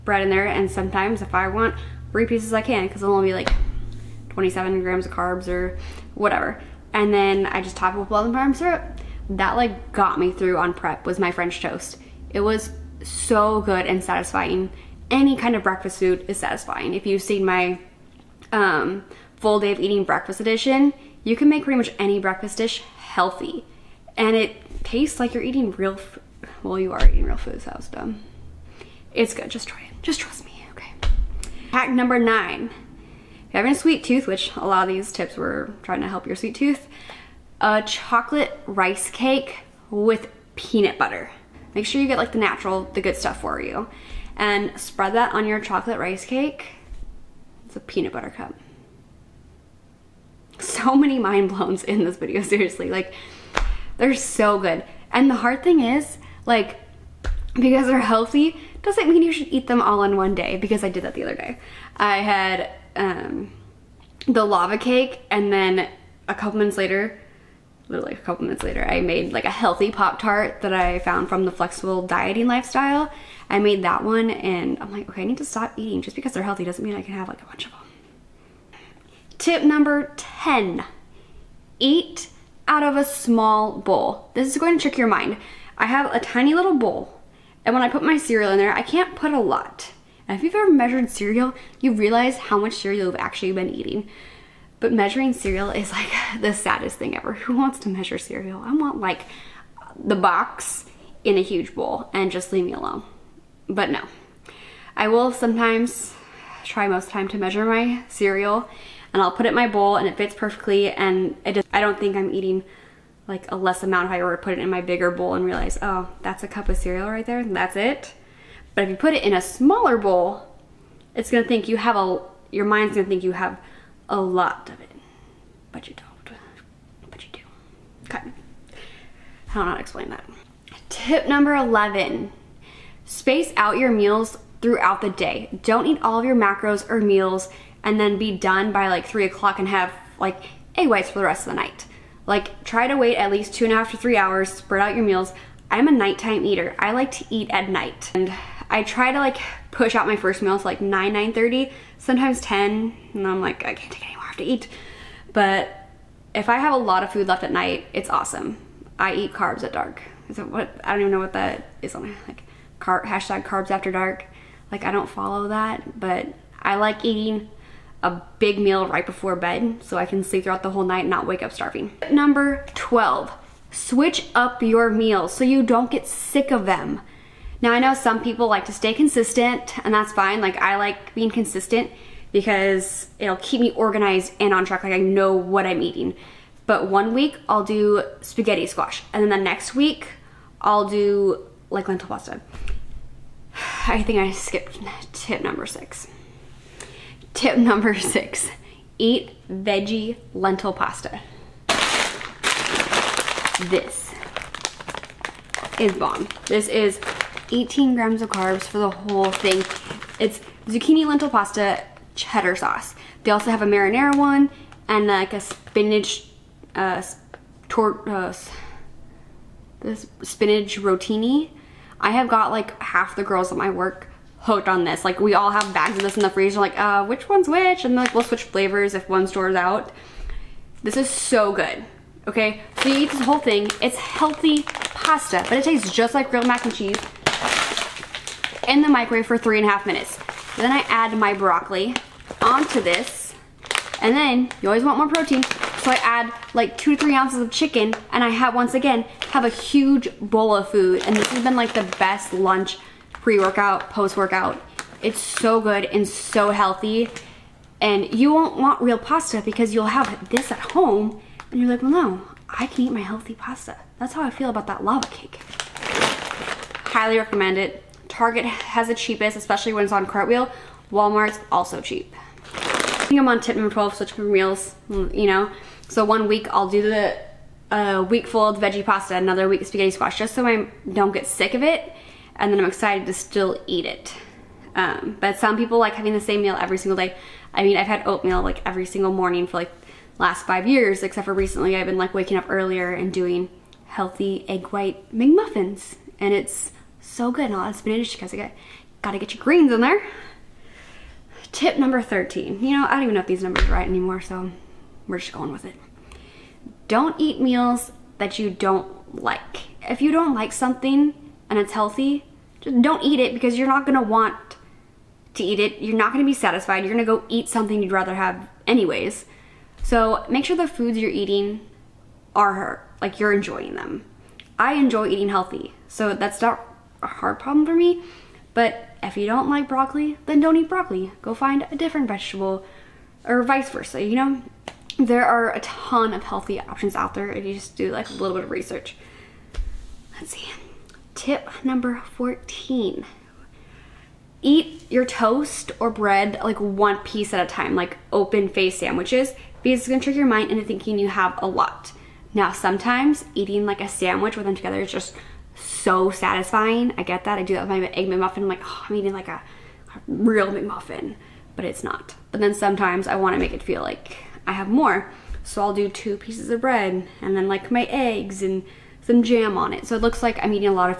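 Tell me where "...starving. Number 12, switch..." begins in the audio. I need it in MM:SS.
02:51.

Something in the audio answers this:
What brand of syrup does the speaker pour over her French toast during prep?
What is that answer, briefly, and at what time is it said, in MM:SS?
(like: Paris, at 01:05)
Walden Farms, at 00:08.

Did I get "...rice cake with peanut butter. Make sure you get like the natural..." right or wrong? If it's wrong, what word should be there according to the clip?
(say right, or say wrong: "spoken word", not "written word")
right.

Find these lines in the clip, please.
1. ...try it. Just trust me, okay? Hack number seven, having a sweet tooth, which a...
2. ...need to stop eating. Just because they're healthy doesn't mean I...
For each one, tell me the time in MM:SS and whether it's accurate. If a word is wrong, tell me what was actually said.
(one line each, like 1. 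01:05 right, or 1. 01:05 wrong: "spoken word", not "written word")
1. 00:29 wrong: "nine", not "seven"
2. 01:15 right.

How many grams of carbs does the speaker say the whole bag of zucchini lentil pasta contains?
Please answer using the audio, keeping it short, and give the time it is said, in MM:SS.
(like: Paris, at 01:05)
18, at 03:27.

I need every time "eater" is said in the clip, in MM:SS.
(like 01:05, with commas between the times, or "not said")
02:26.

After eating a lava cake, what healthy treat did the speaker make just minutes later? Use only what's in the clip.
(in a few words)
Pop-Tart.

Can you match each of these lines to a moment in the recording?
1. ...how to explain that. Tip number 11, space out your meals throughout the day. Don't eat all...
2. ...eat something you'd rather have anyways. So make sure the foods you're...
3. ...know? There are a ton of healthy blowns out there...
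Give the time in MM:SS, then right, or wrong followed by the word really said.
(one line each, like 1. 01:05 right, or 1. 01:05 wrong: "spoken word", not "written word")
1. 02:09 right
2. 05:17 right
3. 05:34 wrong: "options", not "blowns".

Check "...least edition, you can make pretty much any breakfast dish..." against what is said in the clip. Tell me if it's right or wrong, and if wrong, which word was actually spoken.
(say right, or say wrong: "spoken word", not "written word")
wrong: "breakfast", not "least".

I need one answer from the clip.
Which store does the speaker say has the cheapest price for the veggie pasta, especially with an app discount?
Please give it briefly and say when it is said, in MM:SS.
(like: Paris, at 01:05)
Target, at 04:28.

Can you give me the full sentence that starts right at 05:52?
Now, sometimes eating like a sandwich with them together is just so satisfying.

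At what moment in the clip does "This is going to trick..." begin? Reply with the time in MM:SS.
01:24.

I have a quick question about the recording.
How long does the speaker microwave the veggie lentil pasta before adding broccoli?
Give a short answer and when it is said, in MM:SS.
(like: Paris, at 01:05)
3.5 minutes, at 03:59.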